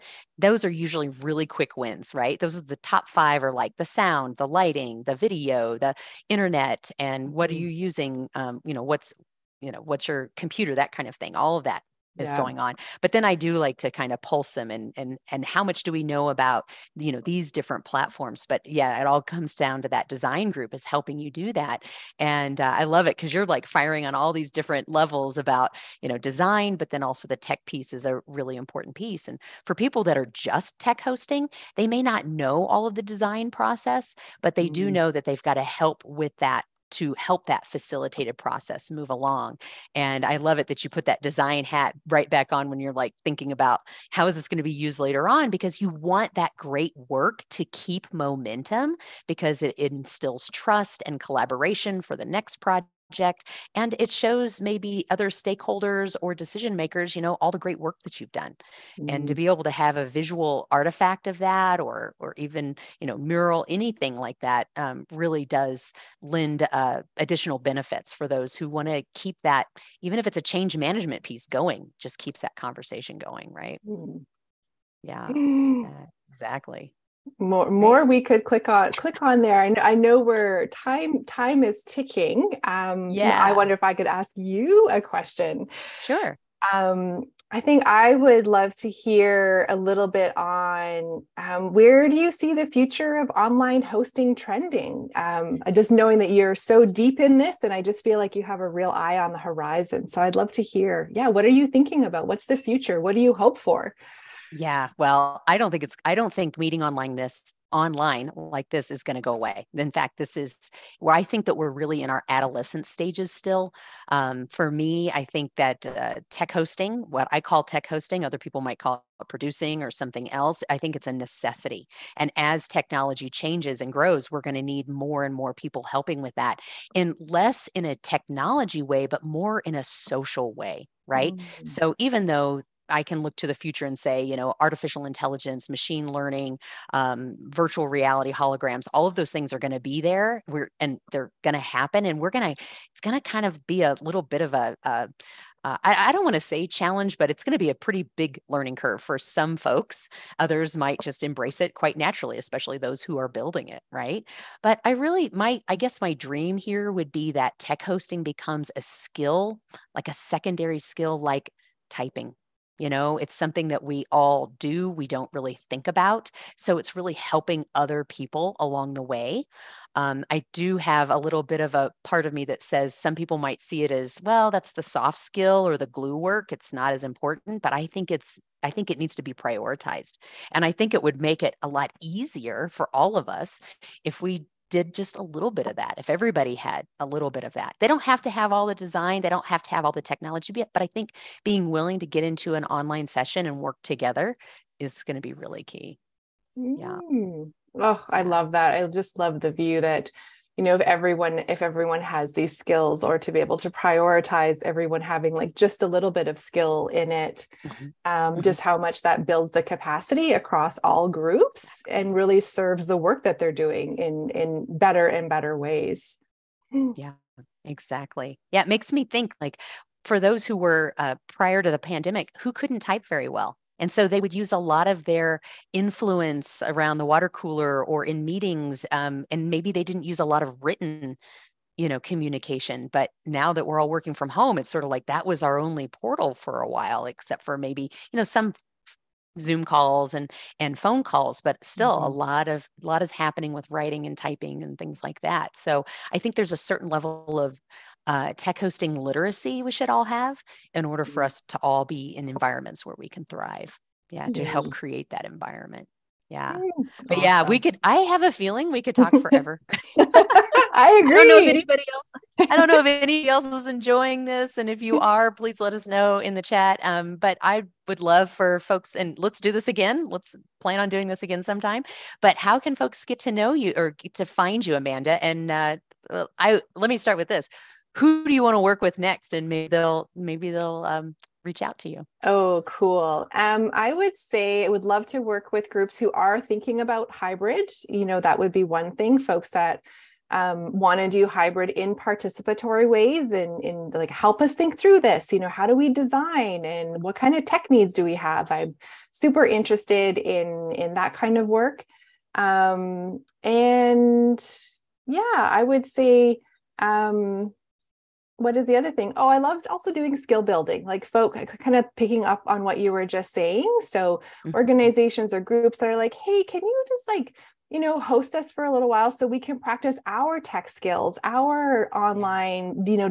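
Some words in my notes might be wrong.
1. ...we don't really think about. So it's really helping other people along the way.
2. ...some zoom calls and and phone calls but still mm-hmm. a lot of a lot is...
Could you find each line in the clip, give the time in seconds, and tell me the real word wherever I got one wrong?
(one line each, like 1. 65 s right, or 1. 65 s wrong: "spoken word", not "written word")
1. 164 s right
2. 238 s right.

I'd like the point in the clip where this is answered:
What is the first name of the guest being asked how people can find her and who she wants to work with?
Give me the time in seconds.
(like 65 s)
274 s.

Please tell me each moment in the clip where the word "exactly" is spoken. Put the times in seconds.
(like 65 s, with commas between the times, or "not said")
76 s, 217 s.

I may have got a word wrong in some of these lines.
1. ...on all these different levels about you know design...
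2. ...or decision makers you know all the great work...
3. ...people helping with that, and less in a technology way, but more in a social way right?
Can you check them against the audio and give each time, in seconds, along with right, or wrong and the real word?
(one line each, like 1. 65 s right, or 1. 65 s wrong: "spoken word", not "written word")
1. 24 s right
2. 56 s right
3. 125 s right.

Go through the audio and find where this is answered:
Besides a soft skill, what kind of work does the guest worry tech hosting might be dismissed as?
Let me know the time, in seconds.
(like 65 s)
175 s.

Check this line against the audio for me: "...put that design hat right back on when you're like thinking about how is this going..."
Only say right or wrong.
right.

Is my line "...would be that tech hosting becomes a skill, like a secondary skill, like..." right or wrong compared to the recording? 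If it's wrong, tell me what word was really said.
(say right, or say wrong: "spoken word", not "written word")
right.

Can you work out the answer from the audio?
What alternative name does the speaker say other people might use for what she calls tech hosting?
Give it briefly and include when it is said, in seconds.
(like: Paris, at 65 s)
Producing, at 119 s.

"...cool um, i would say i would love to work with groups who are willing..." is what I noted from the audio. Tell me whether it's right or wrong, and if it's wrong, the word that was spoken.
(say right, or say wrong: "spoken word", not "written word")
wrong: "thinking", not "willing".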